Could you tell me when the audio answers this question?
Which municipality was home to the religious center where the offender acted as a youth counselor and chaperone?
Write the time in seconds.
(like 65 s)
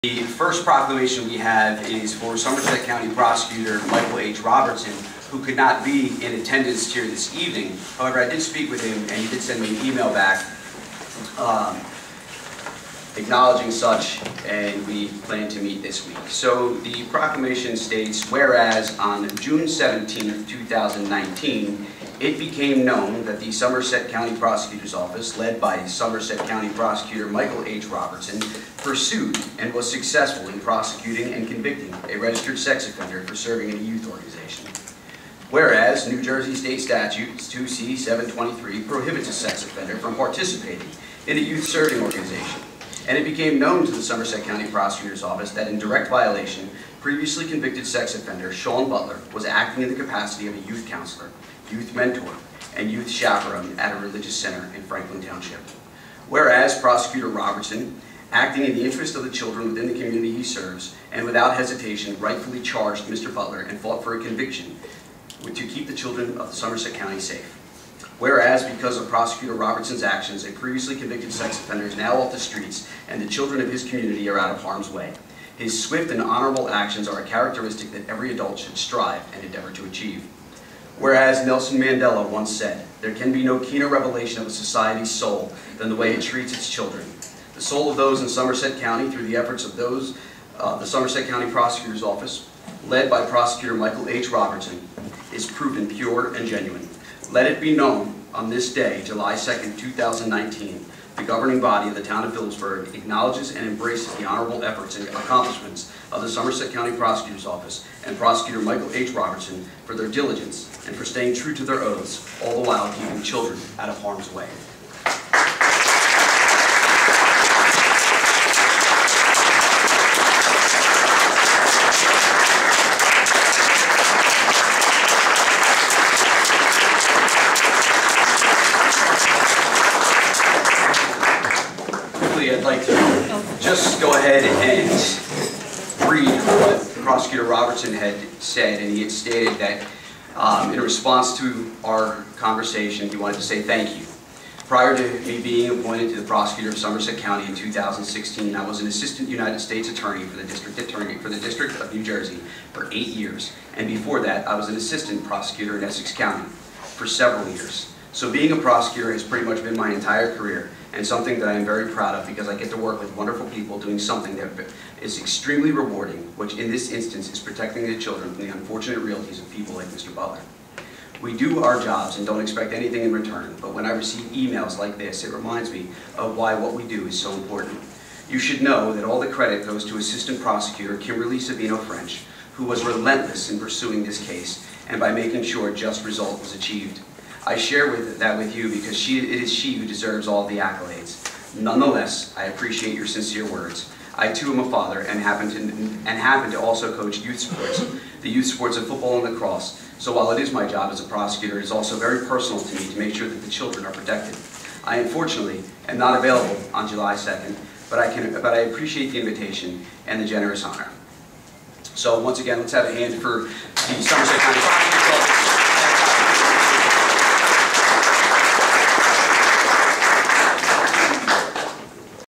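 54 s.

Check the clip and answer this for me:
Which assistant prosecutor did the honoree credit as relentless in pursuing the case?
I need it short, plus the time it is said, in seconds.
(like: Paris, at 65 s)
Kimberly Sabino French, at 180 s.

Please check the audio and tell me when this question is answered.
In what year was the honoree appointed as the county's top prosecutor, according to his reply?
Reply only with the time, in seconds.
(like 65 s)
147 s.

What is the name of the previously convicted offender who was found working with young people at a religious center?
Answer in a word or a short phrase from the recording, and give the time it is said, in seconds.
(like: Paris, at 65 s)
Sean Butler, at 48 s.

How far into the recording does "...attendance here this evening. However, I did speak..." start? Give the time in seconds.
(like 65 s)
6 s.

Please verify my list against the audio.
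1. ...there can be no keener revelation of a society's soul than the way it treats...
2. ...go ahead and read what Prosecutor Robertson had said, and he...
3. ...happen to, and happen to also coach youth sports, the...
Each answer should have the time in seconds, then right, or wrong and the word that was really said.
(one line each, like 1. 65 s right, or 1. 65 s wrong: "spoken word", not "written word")
1. 83 s right
2. 134 s right
3. 195 s right.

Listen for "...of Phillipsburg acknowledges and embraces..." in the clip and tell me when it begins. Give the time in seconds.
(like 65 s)
102 s.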